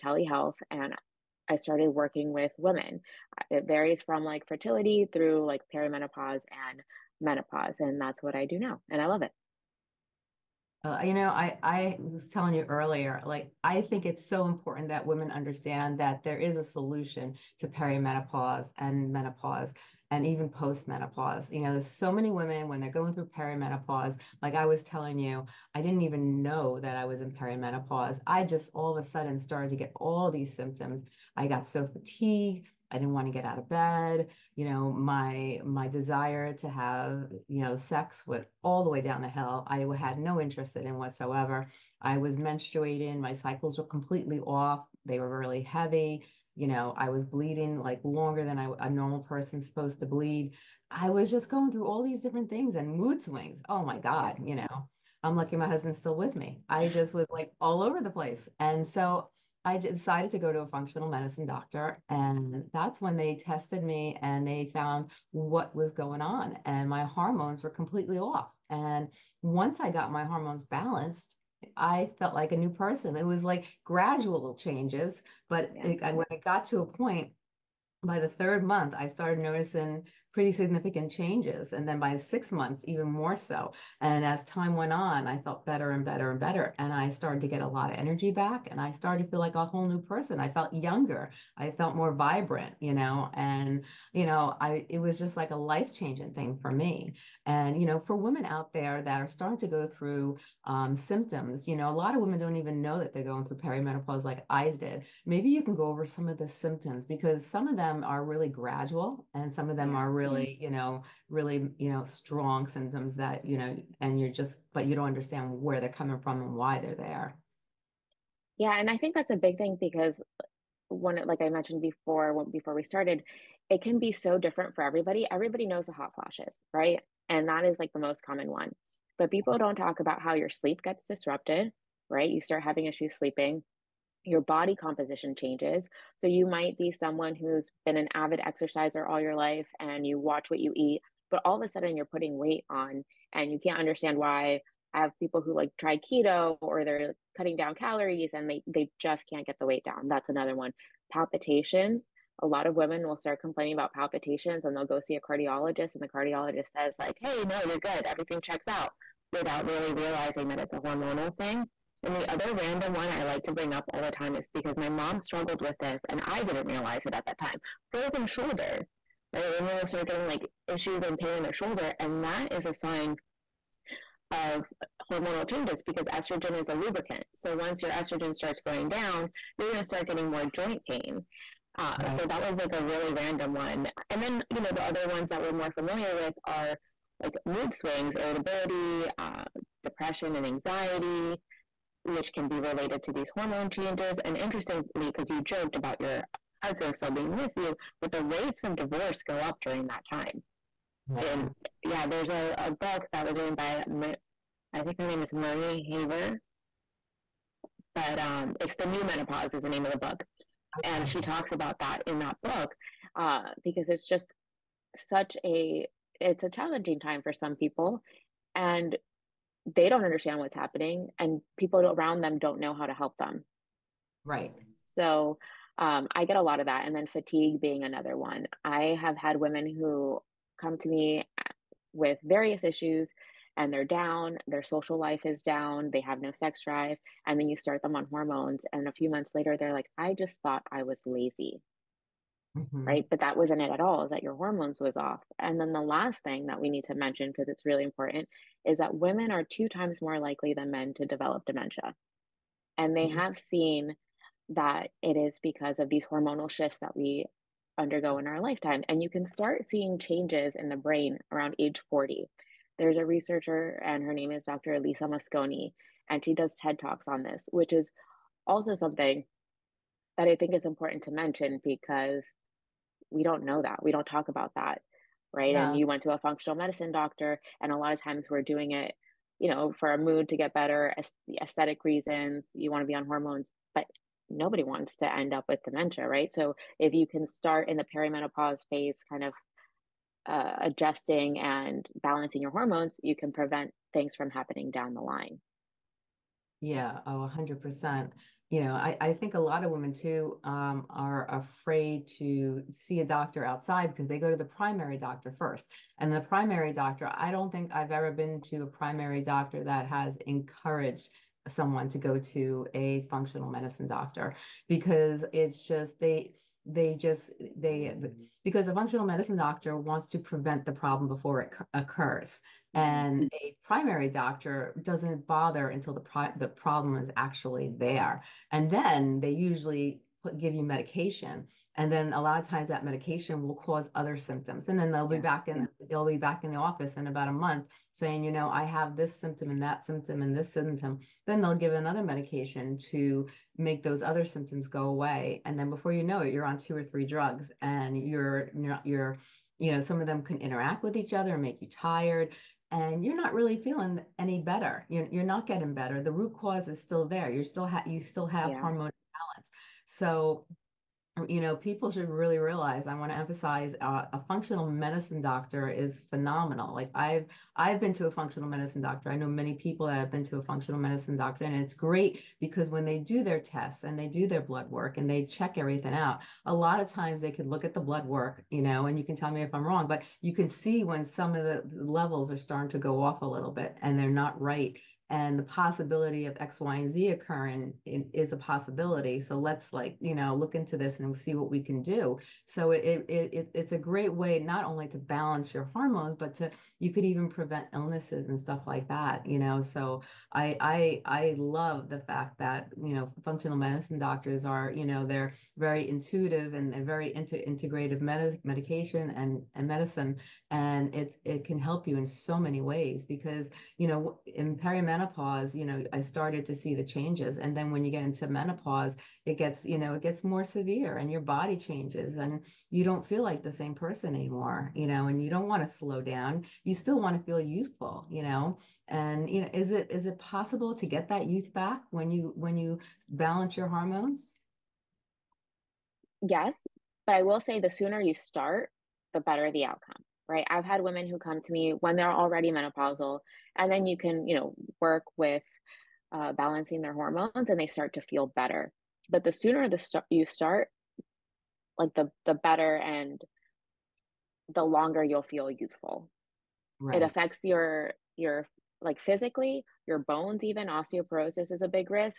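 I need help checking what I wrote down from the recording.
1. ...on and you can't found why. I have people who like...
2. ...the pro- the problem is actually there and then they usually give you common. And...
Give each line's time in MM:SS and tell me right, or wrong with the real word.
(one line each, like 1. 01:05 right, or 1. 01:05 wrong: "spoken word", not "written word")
1. 02:22 wrong: "understand", not "found"
2. 05:25 wrong: "medication", not "common".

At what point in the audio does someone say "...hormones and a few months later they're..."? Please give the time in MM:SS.
03:58.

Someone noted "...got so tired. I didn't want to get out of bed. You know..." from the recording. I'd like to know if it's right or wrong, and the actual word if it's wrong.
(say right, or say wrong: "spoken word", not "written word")
wrong: "fatigued", not "tired".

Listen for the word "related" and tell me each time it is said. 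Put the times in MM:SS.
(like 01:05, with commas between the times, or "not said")
03:12.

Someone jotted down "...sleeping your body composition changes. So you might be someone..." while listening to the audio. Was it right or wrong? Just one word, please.
right.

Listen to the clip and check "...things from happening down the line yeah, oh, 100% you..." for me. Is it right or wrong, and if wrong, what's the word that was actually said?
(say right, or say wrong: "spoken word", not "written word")
right.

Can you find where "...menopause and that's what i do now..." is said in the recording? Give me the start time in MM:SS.
00:07.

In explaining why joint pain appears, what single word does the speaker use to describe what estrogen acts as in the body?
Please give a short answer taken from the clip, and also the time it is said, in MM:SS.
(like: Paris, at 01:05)
lubricant, at 02:56.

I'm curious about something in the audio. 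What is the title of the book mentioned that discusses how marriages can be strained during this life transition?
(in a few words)
The New Menopause.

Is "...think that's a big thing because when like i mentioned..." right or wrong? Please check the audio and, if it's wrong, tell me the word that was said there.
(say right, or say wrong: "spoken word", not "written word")
right.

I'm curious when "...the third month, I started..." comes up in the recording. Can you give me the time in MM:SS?
01:18.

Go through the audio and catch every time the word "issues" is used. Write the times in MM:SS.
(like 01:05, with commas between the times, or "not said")
02:12, 02:50, 03:52.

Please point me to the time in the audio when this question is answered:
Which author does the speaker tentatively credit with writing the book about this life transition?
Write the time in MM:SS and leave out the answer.
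03:25.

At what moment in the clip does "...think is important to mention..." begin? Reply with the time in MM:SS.
04:30.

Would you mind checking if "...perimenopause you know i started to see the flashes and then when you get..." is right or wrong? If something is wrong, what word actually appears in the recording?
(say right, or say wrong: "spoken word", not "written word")
wrong: "changes", not "flashes".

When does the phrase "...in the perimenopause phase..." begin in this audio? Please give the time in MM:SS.
04:47.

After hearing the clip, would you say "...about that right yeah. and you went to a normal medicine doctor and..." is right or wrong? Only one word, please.
wrong.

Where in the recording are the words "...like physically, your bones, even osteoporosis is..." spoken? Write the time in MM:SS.
07:38.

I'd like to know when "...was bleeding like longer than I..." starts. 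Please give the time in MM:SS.
00:47.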